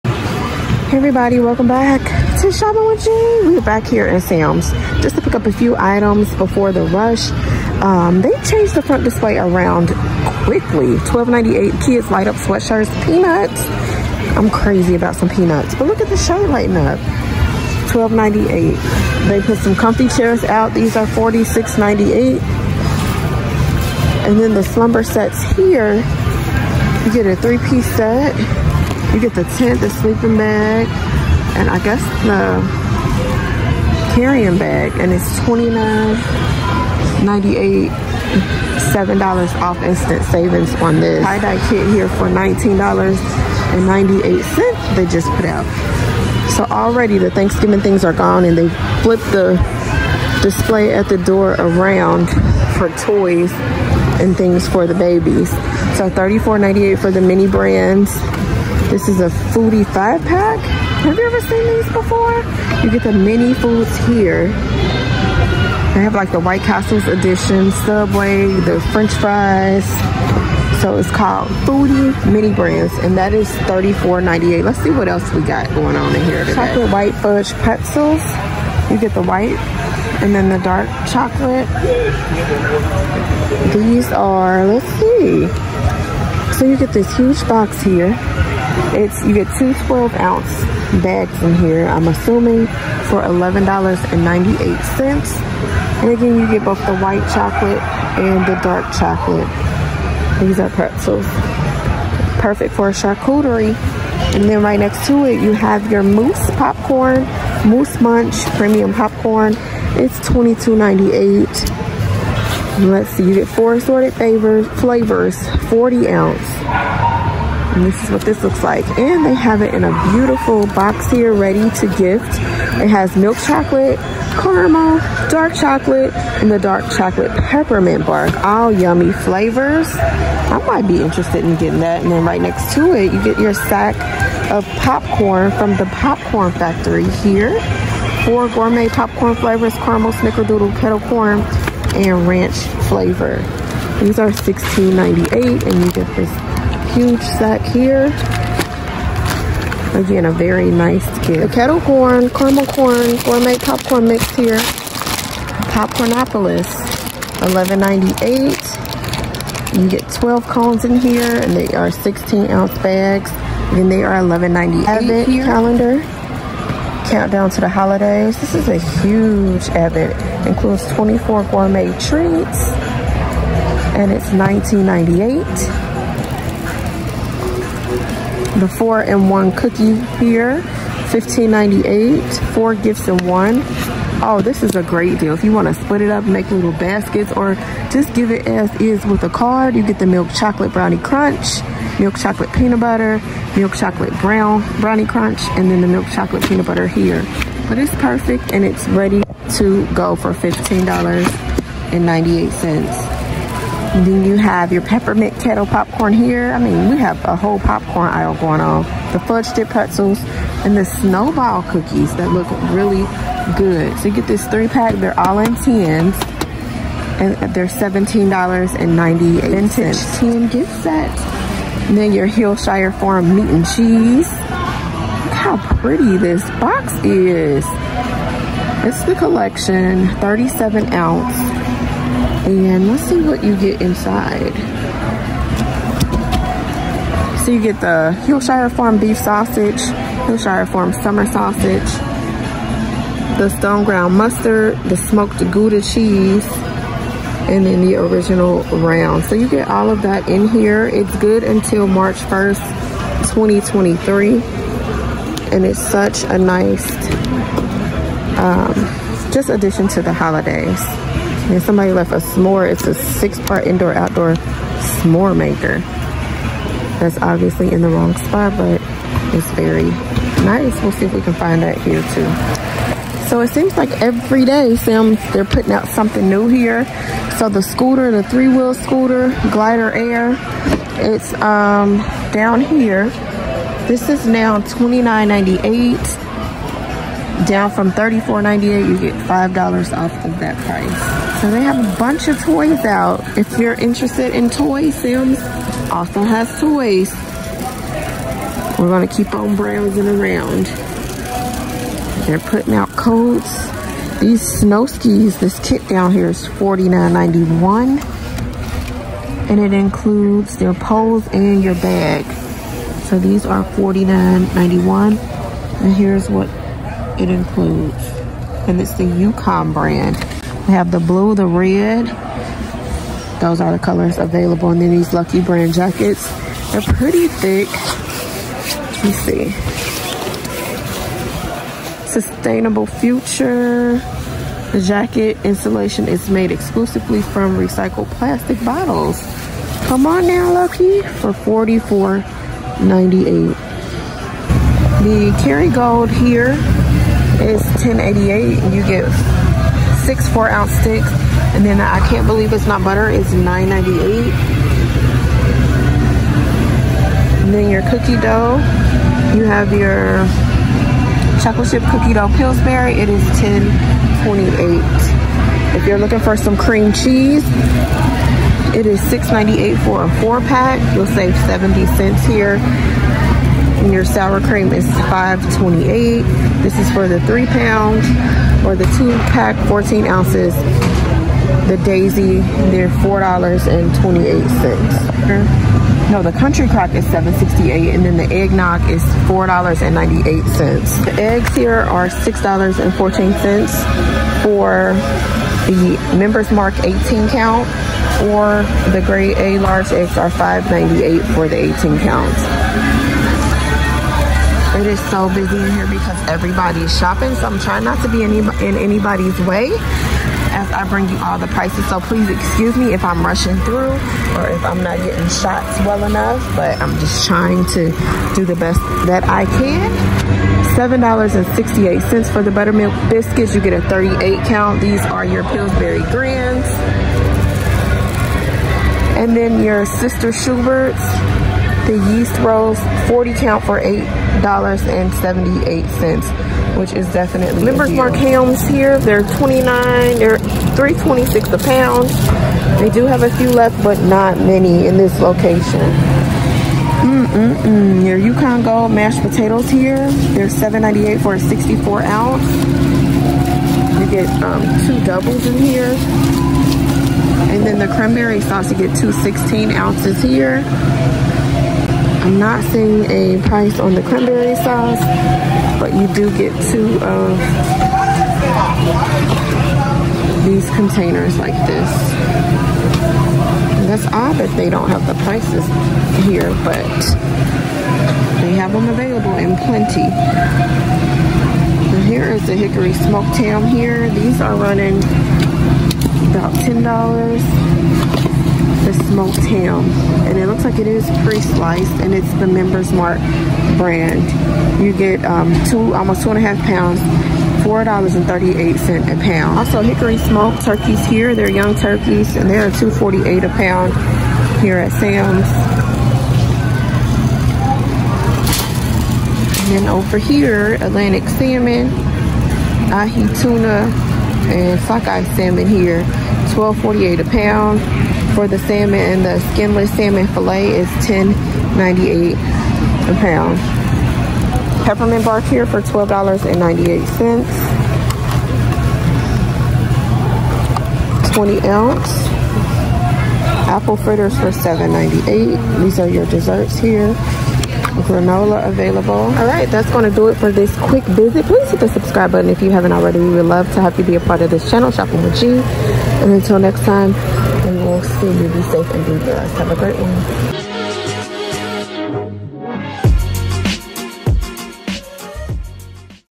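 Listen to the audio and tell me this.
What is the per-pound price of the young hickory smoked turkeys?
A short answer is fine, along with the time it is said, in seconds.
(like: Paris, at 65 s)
$2.48, at 502 s.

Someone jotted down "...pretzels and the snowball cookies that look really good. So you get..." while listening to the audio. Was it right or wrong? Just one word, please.
right.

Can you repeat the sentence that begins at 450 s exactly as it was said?
They're 7.98 for a 64 ounce.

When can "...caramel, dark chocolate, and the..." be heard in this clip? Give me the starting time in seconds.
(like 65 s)
124 s.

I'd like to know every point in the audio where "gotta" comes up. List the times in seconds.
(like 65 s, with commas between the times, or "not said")
not said.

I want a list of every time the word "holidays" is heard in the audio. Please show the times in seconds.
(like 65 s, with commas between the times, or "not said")
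167 s, 260 s.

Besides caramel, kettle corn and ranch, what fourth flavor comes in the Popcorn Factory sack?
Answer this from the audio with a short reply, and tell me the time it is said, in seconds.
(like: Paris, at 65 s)
snickerdoodle, at 140 s.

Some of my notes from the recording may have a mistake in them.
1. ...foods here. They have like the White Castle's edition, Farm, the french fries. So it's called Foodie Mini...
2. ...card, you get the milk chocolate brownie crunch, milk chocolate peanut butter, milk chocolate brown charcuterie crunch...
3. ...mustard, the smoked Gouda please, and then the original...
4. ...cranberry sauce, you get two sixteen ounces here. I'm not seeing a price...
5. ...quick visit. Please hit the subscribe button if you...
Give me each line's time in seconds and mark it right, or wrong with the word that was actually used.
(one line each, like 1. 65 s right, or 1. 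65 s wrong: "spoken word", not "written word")
1. 63 s wrong: "Subway", not "Farm"
2. 189 s wrong: "brownie", not "charcuterie"
3. 244 s wrong: "cheese", not "please"
4. 457 s right
5. 540 s right.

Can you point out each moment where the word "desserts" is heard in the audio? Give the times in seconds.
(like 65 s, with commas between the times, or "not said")
536 s.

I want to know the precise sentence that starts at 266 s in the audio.
That's obviously in the wrong spot, but it's very nice.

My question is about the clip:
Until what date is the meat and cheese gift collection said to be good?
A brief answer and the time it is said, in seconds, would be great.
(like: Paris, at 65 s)
March 1st, 2023, at 251 s.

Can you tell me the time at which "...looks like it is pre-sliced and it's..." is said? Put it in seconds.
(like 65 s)
490 s.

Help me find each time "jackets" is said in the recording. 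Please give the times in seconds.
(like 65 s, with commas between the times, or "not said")
325 s, 334 s.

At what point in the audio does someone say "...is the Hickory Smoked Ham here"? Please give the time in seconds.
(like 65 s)
482 s.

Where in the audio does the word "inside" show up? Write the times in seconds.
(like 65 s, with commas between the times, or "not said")
233 s.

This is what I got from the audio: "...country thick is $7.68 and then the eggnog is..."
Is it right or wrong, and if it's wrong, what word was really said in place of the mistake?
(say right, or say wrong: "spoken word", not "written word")
wrong: "crock", not "thick".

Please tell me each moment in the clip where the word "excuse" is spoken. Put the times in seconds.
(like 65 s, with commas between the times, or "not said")
412 s.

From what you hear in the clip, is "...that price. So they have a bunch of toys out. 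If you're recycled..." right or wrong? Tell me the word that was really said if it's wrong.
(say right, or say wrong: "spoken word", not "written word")
wrong: "interested", not "recycled".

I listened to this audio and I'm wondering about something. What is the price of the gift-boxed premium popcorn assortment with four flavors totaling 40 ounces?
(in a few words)
$22.98.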